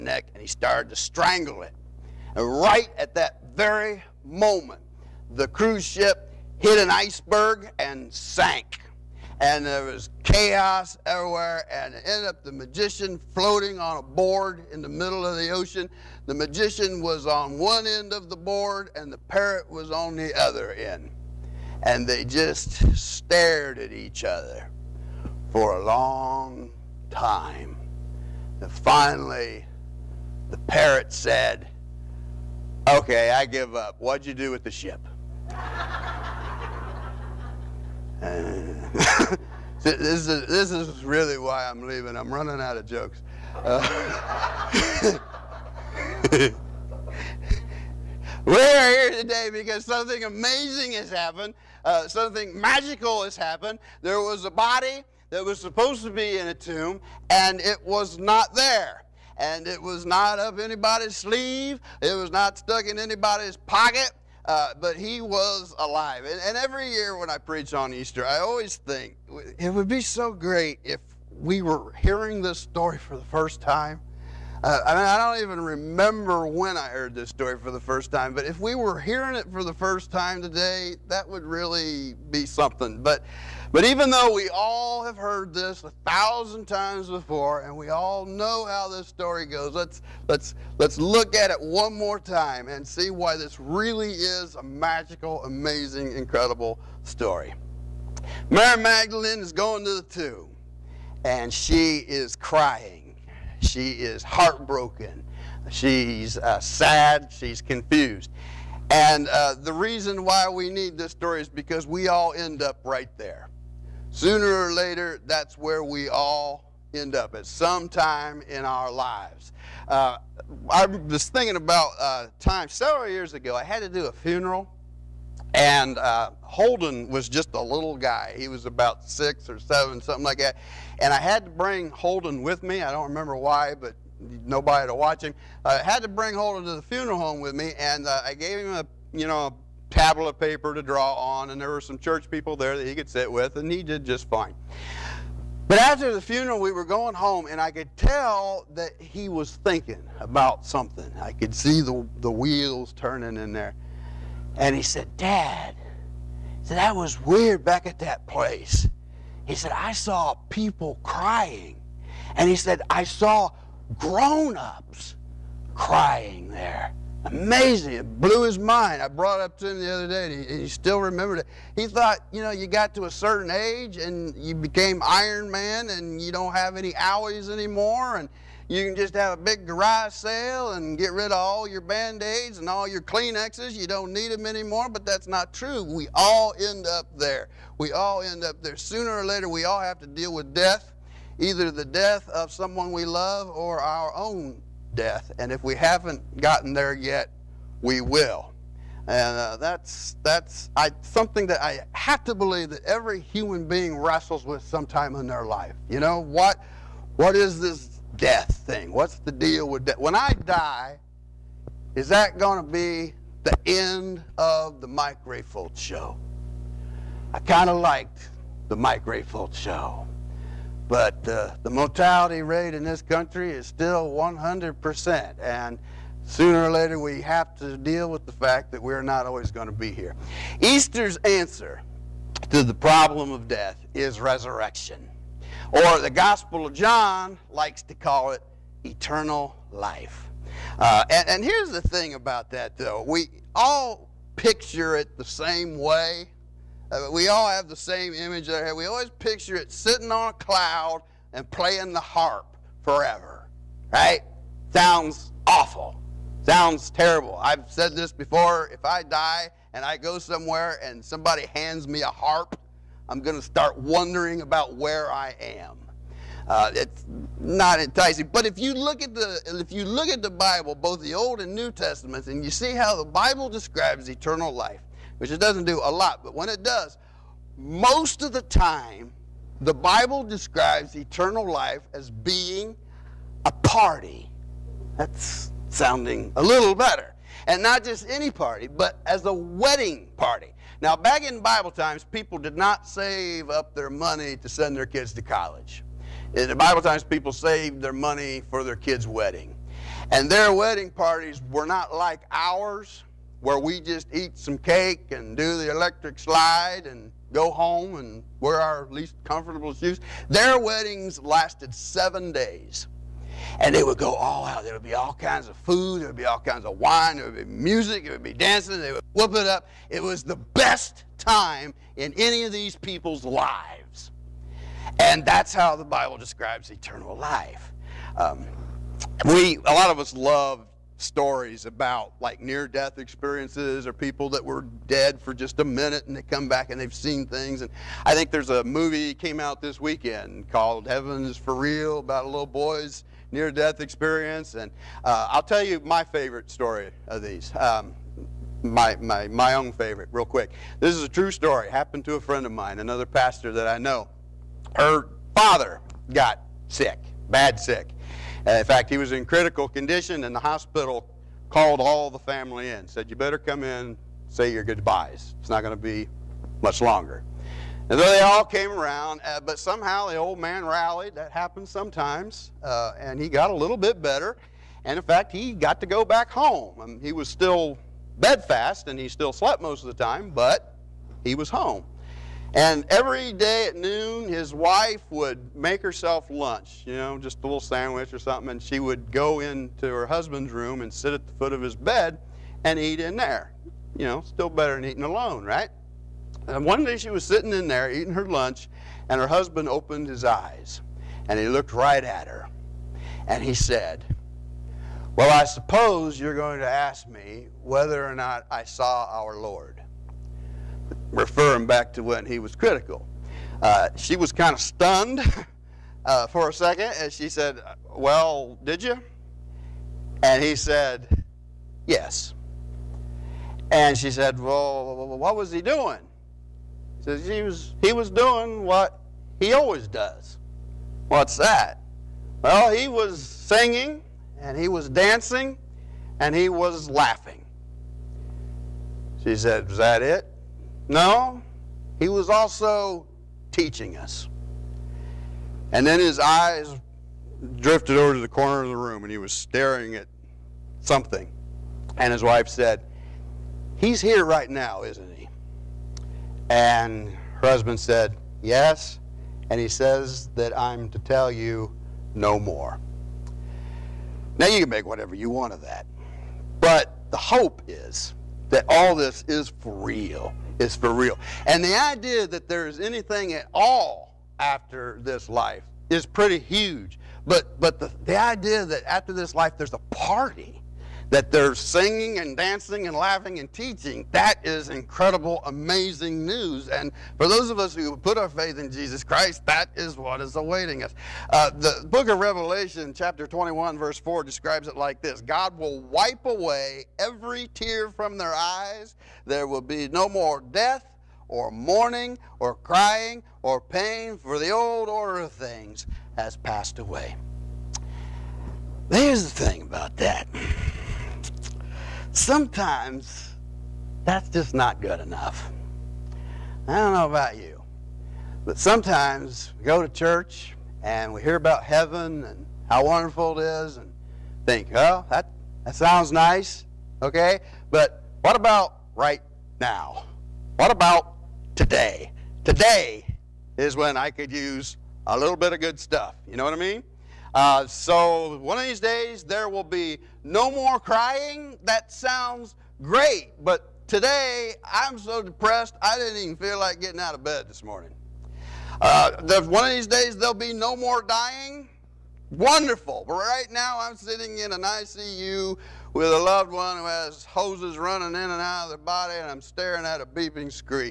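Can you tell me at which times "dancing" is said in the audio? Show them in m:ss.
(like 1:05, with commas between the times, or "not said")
5:18, 7:14, 8:02.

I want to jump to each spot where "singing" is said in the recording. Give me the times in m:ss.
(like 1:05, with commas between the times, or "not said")
7:13, 8:01.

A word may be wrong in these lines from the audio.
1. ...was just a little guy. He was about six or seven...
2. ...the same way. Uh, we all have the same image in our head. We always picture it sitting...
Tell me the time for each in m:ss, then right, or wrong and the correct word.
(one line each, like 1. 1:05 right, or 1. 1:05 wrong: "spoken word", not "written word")
1. 2:07 right
2. 4:05 right.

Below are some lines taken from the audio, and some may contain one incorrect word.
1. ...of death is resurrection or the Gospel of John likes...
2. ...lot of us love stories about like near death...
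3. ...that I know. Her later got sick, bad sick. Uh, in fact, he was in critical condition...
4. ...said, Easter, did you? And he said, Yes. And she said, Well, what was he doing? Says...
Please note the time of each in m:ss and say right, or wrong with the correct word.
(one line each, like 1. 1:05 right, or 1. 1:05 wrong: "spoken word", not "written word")
1. 3:53 right
2. 5:29 right
3. 5:53 wrong: "father", not "later"
4. 6:57 wrong: "Well", not "Easter".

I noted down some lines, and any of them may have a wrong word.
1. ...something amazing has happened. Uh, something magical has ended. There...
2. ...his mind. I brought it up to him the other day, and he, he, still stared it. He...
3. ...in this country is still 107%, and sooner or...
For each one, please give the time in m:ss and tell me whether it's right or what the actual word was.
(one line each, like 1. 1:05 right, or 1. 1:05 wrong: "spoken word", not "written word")
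1. 0:49 wrong: "happened", not "ended"
2. 2:48 wrong: "remembered", not "stared"
3. 3:42 wrong: "100", not "107".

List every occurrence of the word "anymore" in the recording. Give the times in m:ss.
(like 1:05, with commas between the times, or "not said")
2:57, 3:04.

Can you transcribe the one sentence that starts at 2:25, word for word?
But after the funeral, we were going home, and I could tell that he was thinking about something.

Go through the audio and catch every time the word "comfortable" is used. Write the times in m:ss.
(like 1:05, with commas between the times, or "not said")
5:09.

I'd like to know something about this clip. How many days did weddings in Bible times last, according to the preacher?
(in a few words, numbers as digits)
7.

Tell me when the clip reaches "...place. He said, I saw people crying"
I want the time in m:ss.
2:38.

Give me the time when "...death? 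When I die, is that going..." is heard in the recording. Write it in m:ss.
3:29.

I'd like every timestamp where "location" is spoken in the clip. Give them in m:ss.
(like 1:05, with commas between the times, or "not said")
not said.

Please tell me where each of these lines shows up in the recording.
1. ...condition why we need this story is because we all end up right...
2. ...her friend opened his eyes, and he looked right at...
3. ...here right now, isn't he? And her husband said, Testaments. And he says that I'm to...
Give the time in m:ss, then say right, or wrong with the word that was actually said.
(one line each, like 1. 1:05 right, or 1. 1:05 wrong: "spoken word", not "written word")
1. 1:49 wrong: "reason", not "condition"
2. 6:39 wrong: "husband", not "friend"
3. 7:34 wrong: "Yes", not "Testaments".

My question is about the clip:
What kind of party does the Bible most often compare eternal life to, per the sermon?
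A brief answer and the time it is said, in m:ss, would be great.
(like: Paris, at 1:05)
A wedding party, at 4:49.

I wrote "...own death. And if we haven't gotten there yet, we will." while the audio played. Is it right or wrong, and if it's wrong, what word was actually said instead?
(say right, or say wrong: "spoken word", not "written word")
right.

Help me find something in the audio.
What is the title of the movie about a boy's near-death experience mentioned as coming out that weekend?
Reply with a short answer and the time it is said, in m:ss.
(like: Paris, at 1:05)
Heaven's for Real, at 5:40.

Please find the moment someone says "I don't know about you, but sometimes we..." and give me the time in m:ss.
8:36.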